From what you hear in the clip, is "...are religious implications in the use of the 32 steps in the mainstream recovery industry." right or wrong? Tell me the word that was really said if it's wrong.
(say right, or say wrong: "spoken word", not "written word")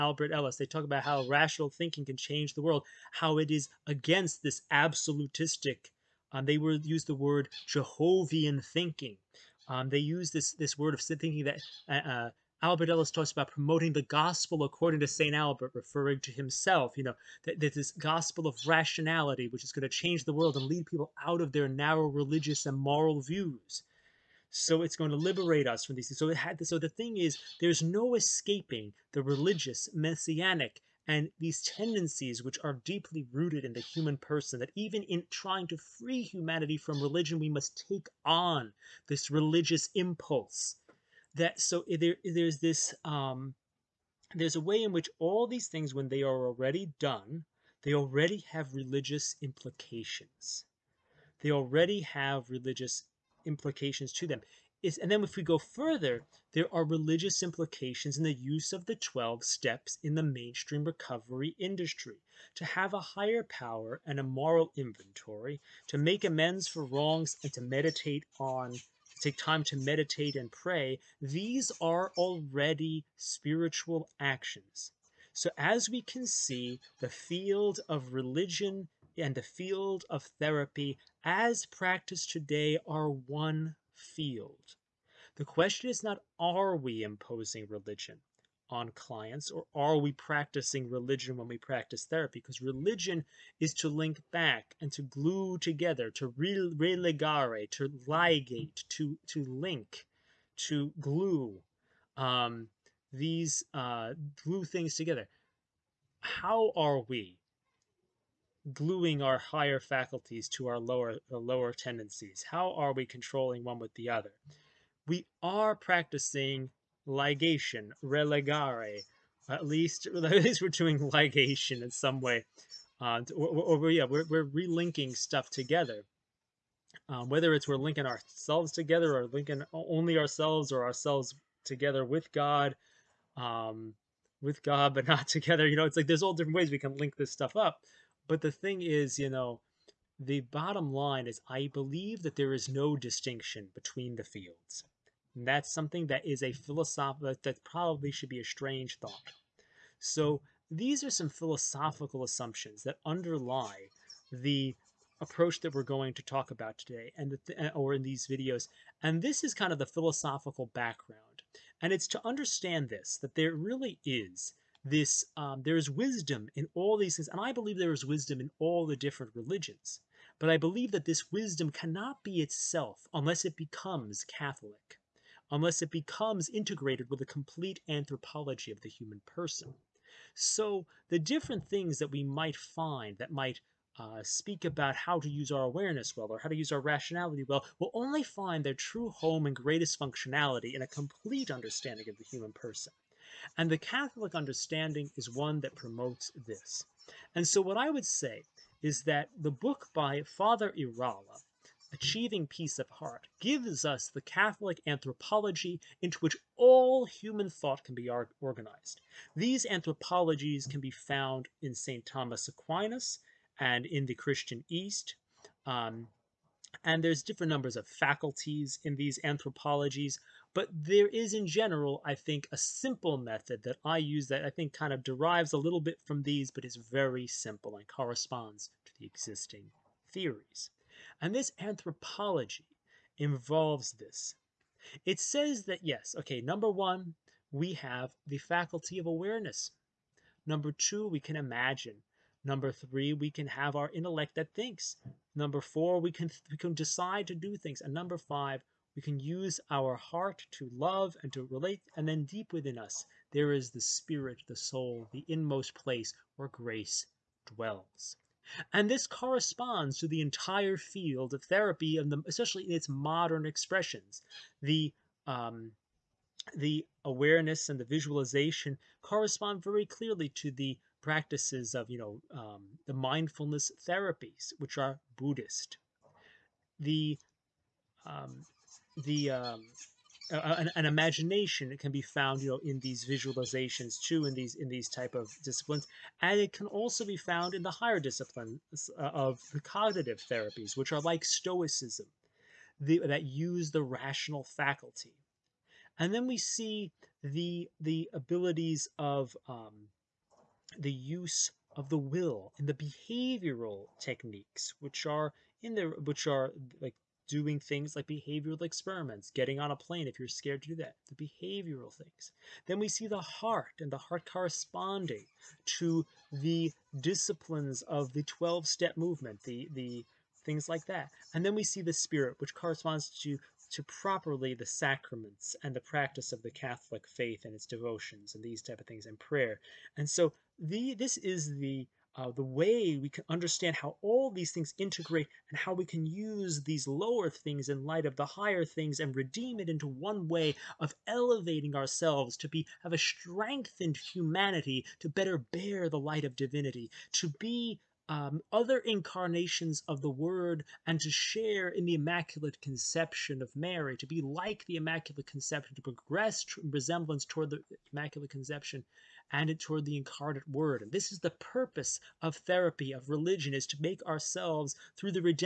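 wrong: "12", not "32".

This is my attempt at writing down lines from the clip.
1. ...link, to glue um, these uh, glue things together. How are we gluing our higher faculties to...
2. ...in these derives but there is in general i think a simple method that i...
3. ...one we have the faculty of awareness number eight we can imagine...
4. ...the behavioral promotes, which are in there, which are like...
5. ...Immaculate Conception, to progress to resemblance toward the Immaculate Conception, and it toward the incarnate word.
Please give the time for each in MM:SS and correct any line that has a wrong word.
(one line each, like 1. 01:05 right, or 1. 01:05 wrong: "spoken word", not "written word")
1. 01:39 right
2. 03:38 wrong: "anthropologies", not "derives"
3. 03:56 wrong: "two", not "eight"
4. 05:02 wrong: "techniques", not "promotes"
5. 05:54 right.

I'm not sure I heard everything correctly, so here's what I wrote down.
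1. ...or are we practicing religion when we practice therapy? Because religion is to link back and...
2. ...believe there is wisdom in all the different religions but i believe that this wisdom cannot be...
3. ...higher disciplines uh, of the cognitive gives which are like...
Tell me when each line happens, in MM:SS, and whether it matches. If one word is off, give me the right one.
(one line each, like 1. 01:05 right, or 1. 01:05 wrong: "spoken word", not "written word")
1. 01:29 right
2. 02:47 right
3. 04:47 wrong: "therapies", not "gives".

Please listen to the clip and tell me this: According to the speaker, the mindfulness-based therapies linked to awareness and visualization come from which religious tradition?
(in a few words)
Buddhist.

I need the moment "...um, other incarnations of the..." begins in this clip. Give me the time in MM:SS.
05:48.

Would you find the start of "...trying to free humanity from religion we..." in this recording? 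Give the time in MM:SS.
00:35.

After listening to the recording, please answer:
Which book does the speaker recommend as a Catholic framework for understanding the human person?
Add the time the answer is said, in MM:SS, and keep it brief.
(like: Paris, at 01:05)
Achieving Peace of Heart, at 03:21.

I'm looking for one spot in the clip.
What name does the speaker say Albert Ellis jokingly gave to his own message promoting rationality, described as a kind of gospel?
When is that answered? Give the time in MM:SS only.
00:14.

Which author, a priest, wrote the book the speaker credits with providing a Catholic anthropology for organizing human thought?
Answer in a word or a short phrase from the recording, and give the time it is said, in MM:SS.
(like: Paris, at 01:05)
Father Irala, at 03:20.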